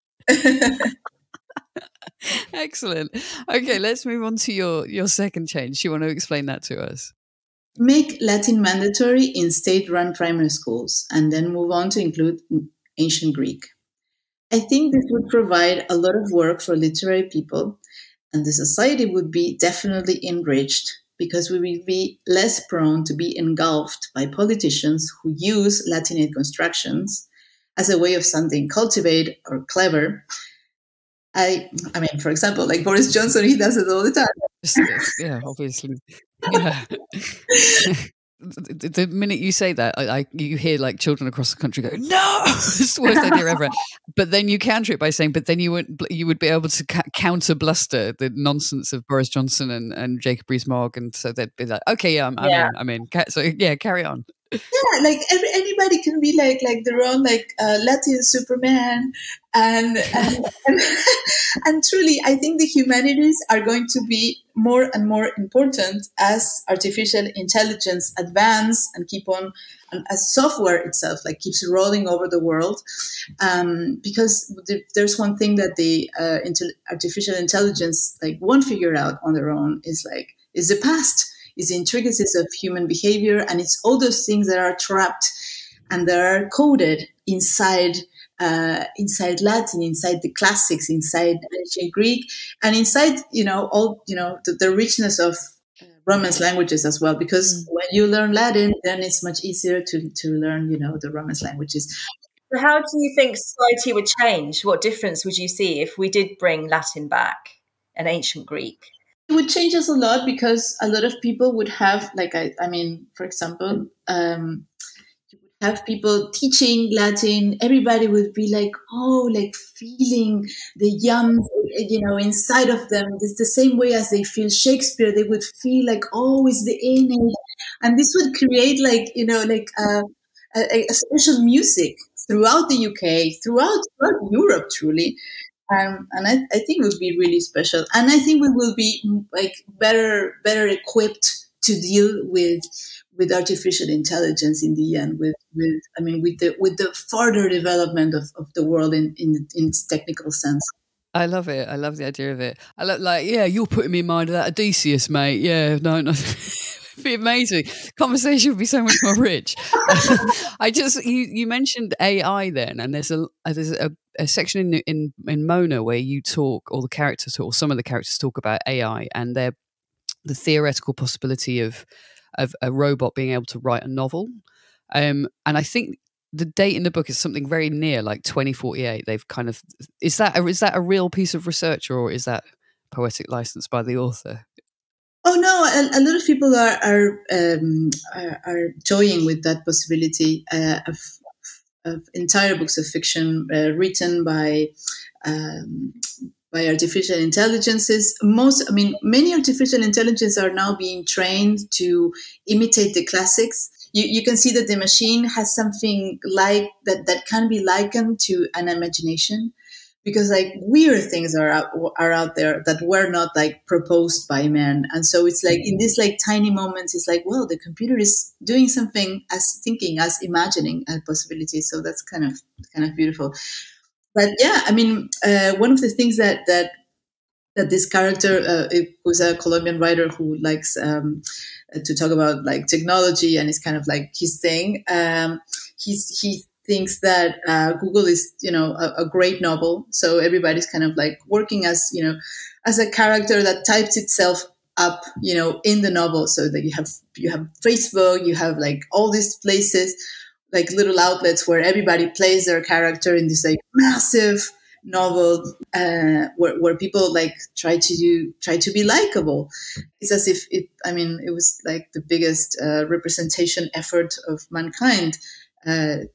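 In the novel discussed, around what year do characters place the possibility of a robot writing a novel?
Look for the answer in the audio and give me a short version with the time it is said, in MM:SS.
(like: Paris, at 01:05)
2048, at 02:58.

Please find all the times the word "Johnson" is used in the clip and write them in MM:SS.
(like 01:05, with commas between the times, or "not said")
00:33, 00:49.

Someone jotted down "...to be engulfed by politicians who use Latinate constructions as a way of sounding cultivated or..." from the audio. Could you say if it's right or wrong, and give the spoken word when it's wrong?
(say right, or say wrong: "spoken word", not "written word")
right.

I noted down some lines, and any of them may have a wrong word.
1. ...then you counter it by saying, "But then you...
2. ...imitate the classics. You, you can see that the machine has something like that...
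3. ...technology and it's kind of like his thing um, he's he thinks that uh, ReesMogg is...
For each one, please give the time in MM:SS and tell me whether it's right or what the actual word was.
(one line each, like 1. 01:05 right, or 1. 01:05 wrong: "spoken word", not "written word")
1. 00:44 right
2. 03:22 right
3. 03:52 wrong: "Google", not "ReesMogg".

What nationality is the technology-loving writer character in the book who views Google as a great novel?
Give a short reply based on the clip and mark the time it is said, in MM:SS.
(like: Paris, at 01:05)
Colombian, at 03:49.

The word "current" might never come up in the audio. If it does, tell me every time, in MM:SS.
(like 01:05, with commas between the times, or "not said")
not said.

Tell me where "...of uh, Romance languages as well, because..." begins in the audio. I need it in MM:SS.
01:35.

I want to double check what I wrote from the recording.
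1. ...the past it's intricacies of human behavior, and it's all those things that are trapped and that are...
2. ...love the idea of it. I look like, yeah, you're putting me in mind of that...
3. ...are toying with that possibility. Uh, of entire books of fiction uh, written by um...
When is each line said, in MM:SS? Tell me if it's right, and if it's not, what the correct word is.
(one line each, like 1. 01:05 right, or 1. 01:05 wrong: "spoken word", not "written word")
1. 01:20 right
2. 02:31 right
3. 03:08 right.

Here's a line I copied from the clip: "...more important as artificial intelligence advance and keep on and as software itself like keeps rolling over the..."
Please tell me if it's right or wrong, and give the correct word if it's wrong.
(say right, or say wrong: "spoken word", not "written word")
right.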